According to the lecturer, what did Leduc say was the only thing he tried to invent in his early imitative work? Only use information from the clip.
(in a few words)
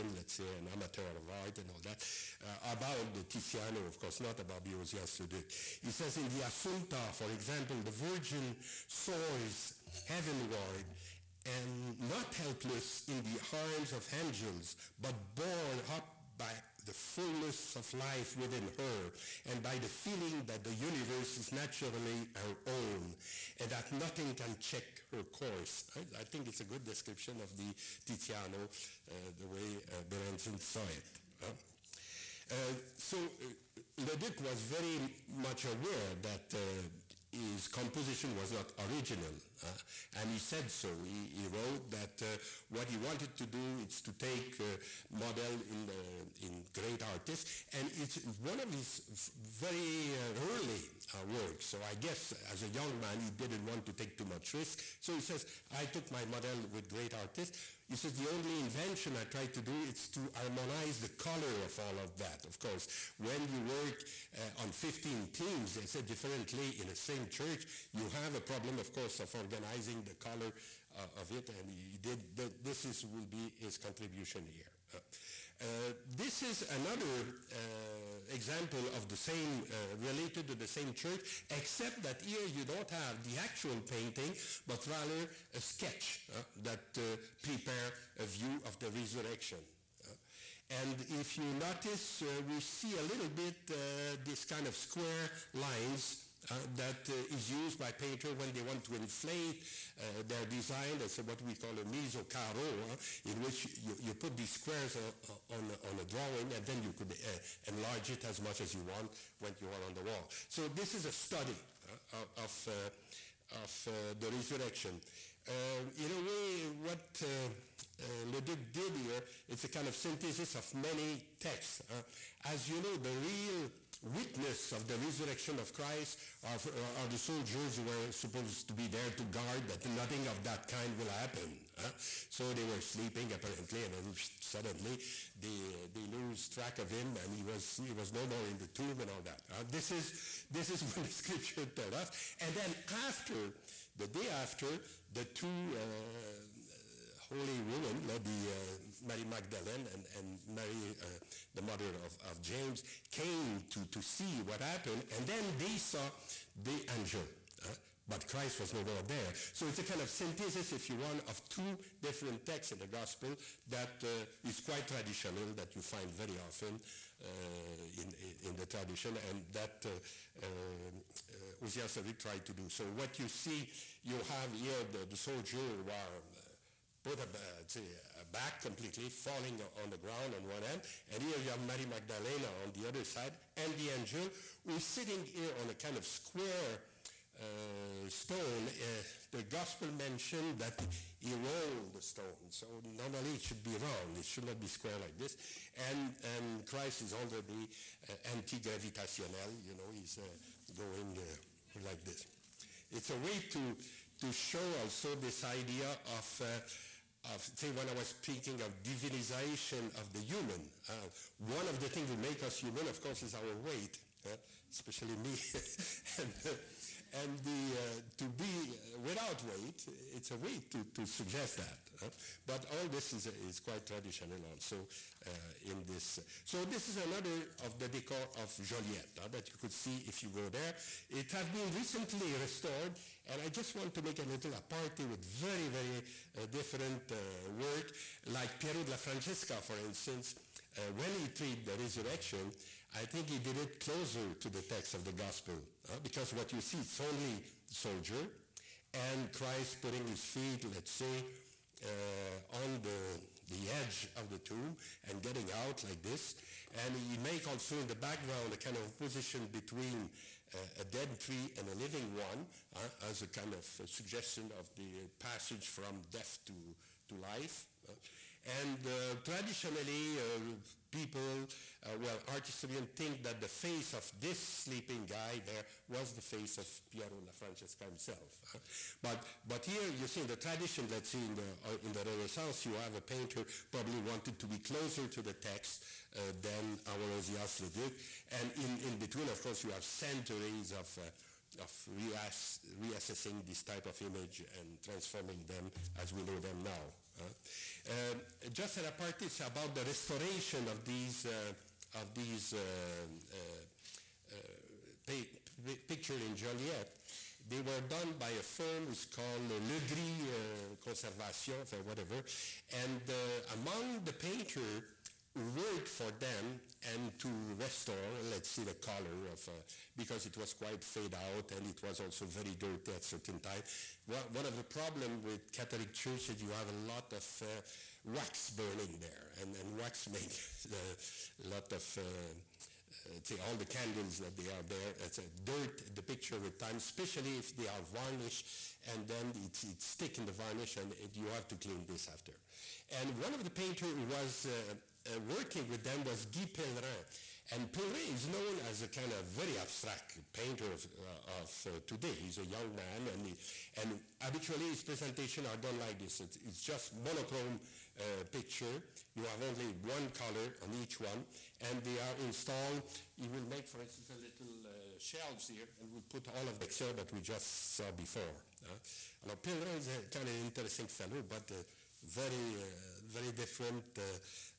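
harmonize the color.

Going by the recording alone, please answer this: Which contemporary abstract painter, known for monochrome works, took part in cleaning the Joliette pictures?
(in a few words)
Guy Pellerin.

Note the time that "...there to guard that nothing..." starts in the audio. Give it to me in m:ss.
2:08.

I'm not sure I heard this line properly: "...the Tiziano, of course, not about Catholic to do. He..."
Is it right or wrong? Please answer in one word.
wrong.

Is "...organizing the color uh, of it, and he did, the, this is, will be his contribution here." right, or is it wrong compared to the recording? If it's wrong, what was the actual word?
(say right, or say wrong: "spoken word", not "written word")
right.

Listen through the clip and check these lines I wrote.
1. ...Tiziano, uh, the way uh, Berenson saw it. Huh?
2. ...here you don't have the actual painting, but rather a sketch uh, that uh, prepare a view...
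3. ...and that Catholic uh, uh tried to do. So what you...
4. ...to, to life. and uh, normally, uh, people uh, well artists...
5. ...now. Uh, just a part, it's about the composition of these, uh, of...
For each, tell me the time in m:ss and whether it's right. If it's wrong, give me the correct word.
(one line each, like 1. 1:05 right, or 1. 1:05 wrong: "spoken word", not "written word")
1. 0:28 right
2. 1:22 right
3. 2:49 wrong: "Ozias", not "Catholic"
4. 4:26 wrong: "traditionally", not "normally"
5. 4:56 wrong: "restoration", not "composition".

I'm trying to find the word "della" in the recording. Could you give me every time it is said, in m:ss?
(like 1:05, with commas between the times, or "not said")
3:58, 4:37.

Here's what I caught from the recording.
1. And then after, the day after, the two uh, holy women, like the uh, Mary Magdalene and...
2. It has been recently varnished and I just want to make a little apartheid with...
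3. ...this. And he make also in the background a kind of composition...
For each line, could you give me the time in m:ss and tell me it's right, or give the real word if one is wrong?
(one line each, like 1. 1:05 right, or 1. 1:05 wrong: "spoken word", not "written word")
1. 2:22 right
2. 3:51 wrong: "restored", not "varnished"
3. 4:16 wrong: "opposition", not "composition".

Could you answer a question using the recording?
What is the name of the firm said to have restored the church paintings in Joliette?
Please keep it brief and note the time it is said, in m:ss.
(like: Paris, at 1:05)
Le Gris Conservation, at 5:09.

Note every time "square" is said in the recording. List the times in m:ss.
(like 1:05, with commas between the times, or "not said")
1:34, 1:44, 3:06, 3:14.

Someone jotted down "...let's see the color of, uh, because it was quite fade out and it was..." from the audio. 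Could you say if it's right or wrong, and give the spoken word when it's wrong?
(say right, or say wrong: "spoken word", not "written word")
right.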